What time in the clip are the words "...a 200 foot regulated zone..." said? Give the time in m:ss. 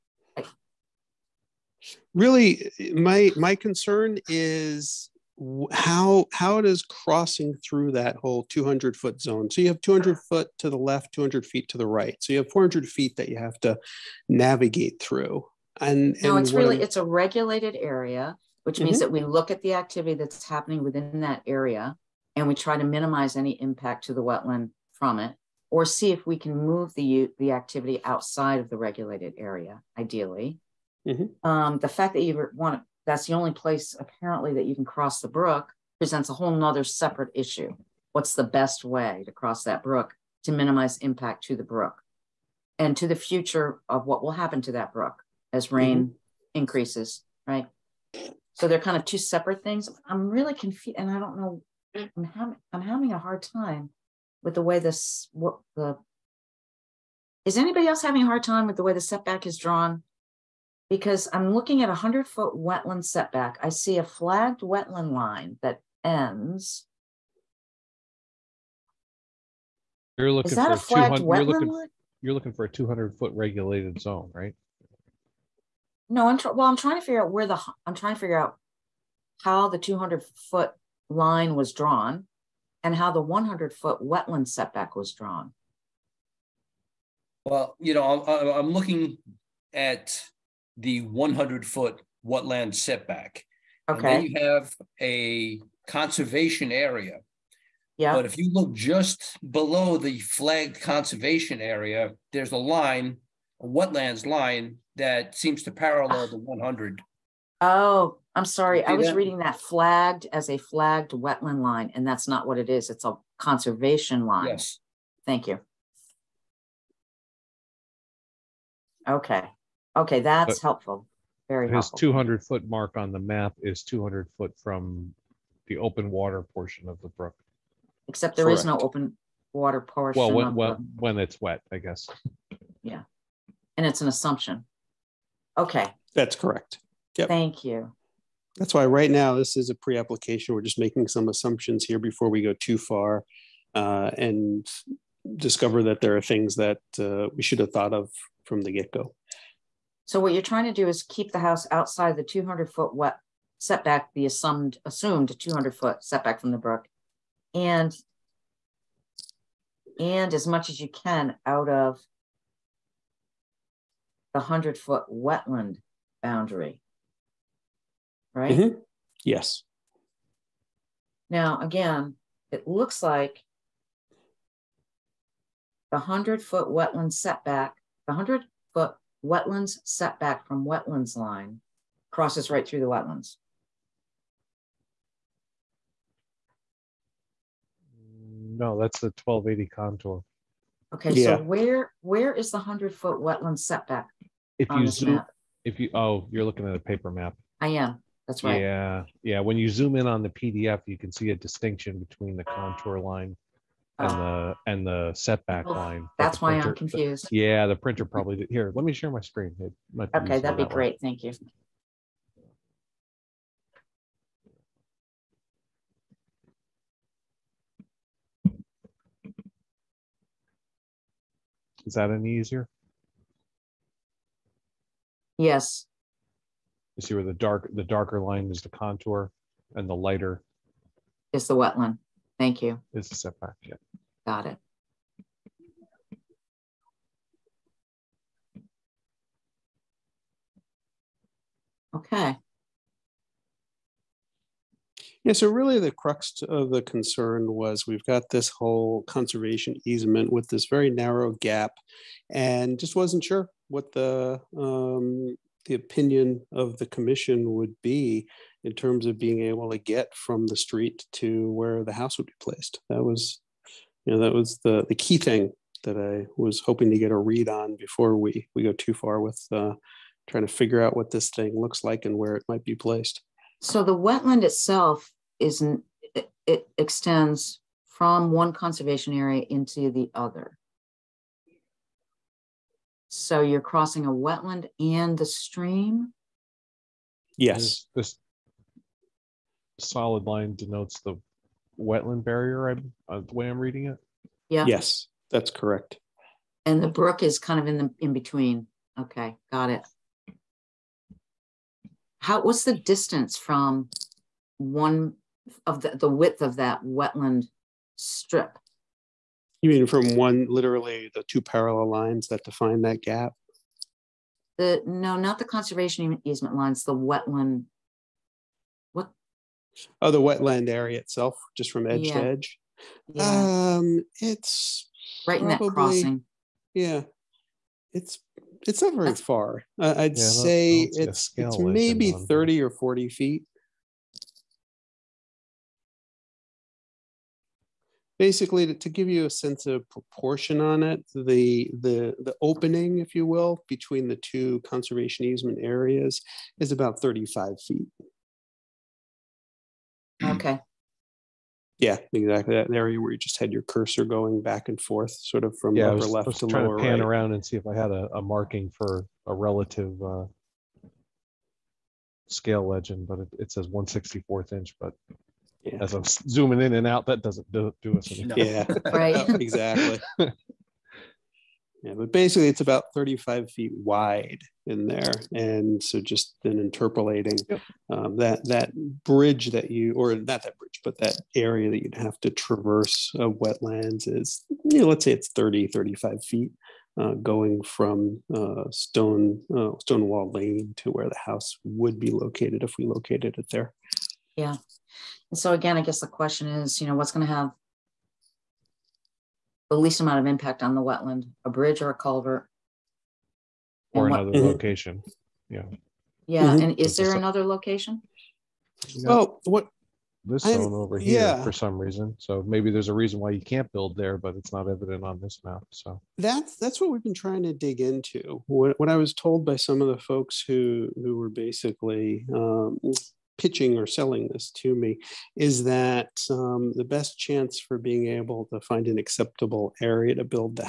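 1:12.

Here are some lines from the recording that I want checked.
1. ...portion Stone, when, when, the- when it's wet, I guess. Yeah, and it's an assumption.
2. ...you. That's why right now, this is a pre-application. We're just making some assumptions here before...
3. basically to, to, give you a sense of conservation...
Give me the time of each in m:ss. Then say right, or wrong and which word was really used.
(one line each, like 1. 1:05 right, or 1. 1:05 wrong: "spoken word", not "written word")
1. 2:09 wrong: "Well", not "Stone"
2. 2:17 right
3. 5:38 wrong: "proportion", not "conservation".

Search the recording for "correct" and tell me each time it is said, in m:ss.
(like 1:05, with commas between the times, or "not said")
2:16, 4:55.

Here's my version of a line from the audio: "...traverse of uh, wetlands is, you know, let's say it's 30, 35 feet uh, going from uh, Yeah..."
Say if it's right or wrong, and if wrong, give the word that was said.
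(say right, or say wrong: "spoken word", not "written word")
wrong: "Stone", not "Yeah".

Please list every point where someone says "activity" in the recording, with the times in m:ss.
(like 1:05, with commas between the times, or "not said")
0:19, 0:27.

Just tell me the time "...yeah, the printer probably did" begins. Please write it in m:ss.
3:27.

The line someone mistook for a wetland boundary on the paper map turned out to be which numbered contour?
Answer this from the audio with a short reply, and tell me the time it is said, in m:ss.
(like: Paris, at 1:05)
1280, at 3:09.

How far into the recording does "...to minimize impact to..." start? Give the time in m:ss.
0:40.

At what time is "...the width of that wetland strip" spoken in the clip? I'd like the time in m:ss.
5:05.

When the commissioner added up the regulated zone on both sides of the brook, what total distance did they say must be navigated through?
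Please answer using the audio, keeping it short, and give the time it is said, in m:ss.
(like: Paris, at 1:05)
400 feet, at 0:12.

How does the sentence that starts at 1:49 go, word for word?
reading that flagged as a flagged wetland line, and that's not what it is.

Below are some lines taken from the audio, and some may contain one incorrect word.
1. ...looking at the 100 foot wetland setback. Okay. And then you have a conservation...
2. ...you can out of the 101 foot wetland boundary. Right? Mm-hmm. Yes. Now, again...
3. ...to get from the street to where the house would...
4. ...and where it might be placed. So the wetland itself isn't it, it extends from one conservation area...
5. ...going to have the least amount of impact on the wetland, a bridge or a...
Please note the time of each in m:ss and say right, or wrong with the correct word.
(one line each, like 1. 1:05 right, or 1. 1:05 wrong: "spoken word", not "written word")
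1. 1:28 right
2. 2:40 wrong: "100", not "101"
3. 4:19 right
4. 4:32 right
5. 6:37 right.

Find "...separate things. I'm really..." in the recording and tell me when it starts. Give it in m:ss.
0:49.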